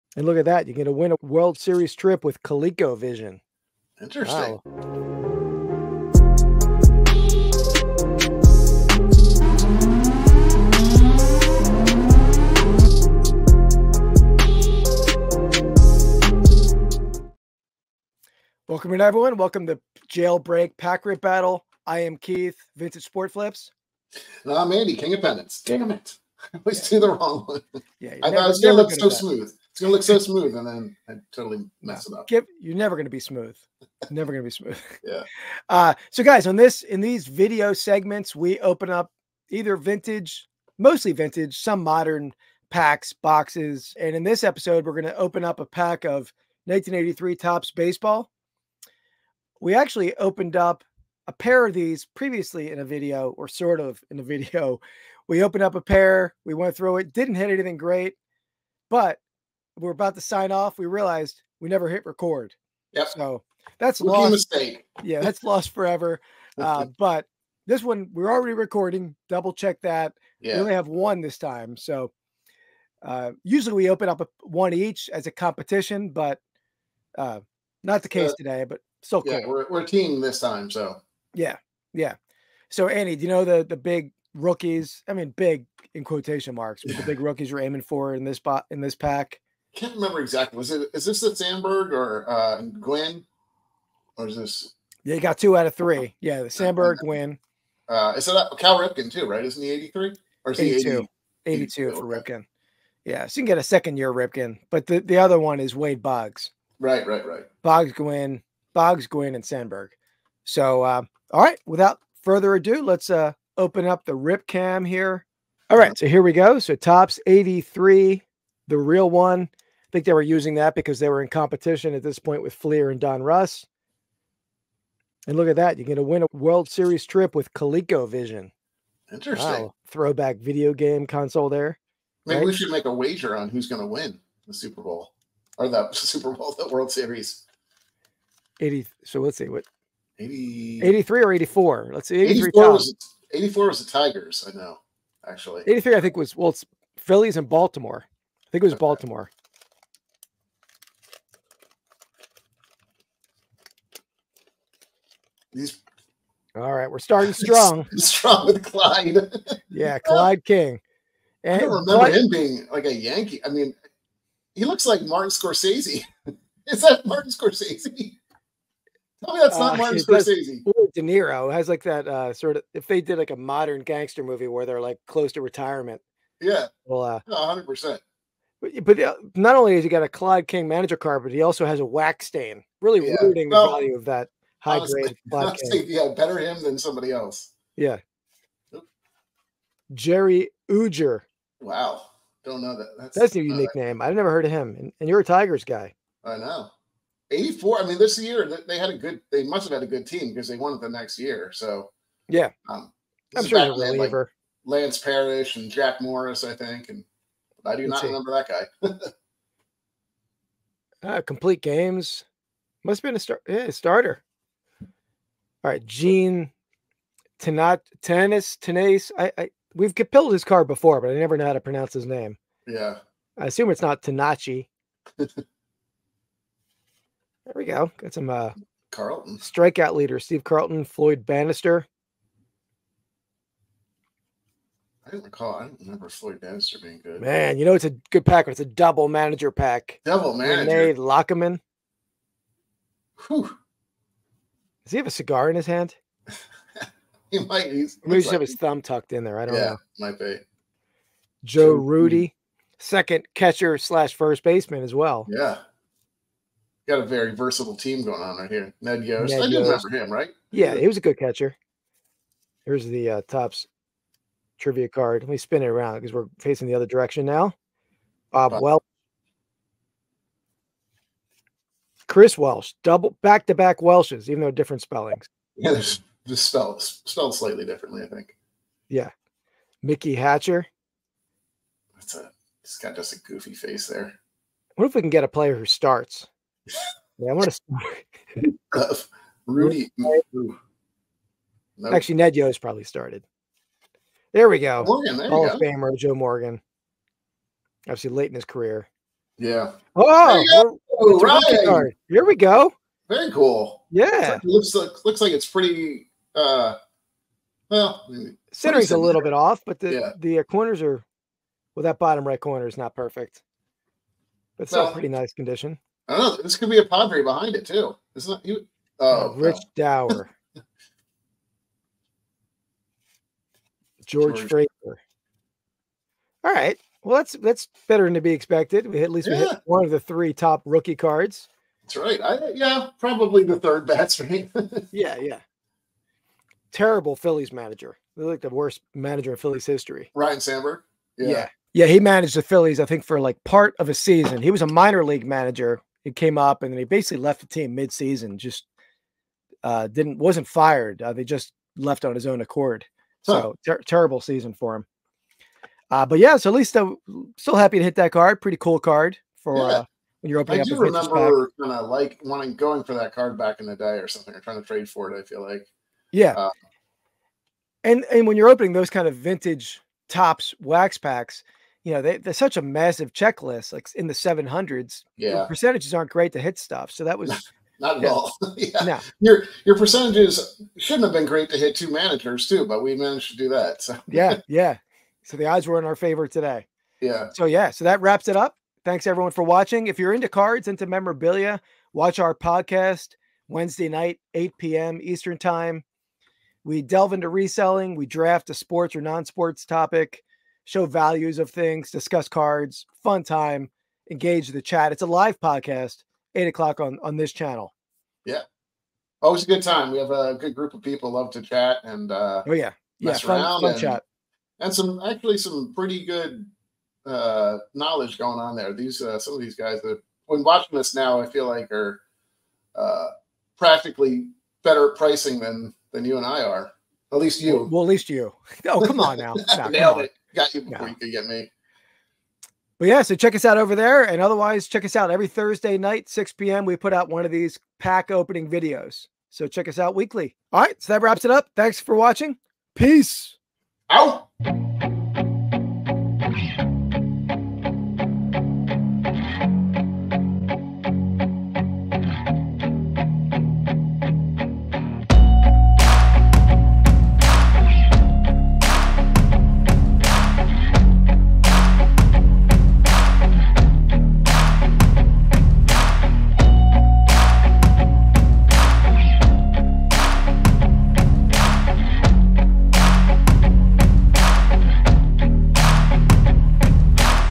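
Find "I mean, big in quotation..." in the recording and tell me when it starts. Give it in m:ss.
1:25.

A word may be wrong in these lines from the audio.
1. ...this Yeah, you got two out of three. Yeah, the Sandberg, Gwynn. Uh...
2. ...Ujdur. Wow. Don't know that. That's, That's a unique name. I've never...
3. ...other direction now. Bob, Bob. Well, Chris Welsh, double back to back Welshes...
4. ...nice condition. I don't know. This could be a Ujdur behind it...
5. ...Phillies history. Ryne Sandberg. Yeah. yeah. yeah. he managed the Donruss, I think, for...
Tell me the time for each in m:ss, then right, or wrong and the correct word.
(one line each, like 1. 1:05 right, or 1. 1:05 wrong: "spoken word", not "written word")
1. 1:34 right
2. 3:10 right
3. 4:26 right
4. 5:15 wrong: "Padre", not "Ujdur"
5. 5:39 wrong: "Phillies", not "Donruss".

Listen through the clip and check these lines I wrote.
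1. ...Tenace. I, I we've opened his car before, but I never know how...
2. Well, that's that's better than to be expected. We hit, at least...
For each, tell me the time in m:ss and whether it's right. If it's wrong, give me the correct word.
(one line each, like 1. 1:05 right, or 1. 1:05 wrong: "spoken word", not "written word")
1. 3:38 wrong: "killed", not "opened"
2. 5:27 right.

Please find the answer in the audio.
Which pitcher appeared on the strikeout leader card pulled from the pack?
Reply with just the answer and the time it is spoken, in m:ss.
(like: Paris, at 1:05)
Steve Carlton, at 3:50.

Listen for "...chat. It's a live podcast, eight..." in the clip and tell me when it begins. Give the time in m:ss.
6:44.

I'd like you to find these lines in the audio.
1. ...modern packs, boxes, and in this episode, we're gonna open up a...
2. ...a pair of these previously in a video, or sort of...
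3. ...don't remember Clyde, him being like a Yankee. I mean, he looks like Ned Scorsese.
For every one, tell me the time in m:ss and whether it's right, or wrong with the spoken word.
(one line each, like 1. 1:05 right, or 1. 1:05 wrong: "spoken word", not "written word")
1. 0:41 right
2. 0:51 right
3. 2:41 wrong: "Martin", not "Ned".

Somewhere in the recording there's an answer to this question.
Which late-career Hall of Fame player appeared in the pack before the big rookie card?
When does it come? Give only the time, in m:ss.
4:55.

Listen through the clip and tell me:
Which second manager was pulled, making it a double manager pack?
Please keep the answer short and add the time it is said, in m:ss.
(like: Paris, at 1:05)
Rene Lachemann, at 4:00.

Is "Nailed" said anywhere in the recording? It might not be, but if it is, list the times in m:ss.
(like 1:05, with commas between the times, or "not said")
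7:09.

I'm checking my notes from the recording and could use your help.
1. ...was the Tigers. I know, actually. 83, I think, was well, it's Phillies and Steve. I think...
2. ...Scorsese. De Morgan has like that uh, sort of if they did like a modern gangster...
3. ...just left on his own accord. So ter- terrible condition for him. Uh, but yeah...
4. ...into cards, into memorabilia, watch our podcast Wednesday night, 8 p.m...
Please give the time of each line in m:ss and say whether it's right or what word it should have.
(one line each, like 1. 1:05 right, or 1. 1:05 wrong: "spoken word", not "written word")
1. 2:23 wrong: "Baltimore", not "Steve"
2. 2:49 wrong: "Niro", not "Morgan"
3. 5:51 wrong: "season", not "condition"
4. 6:30 right.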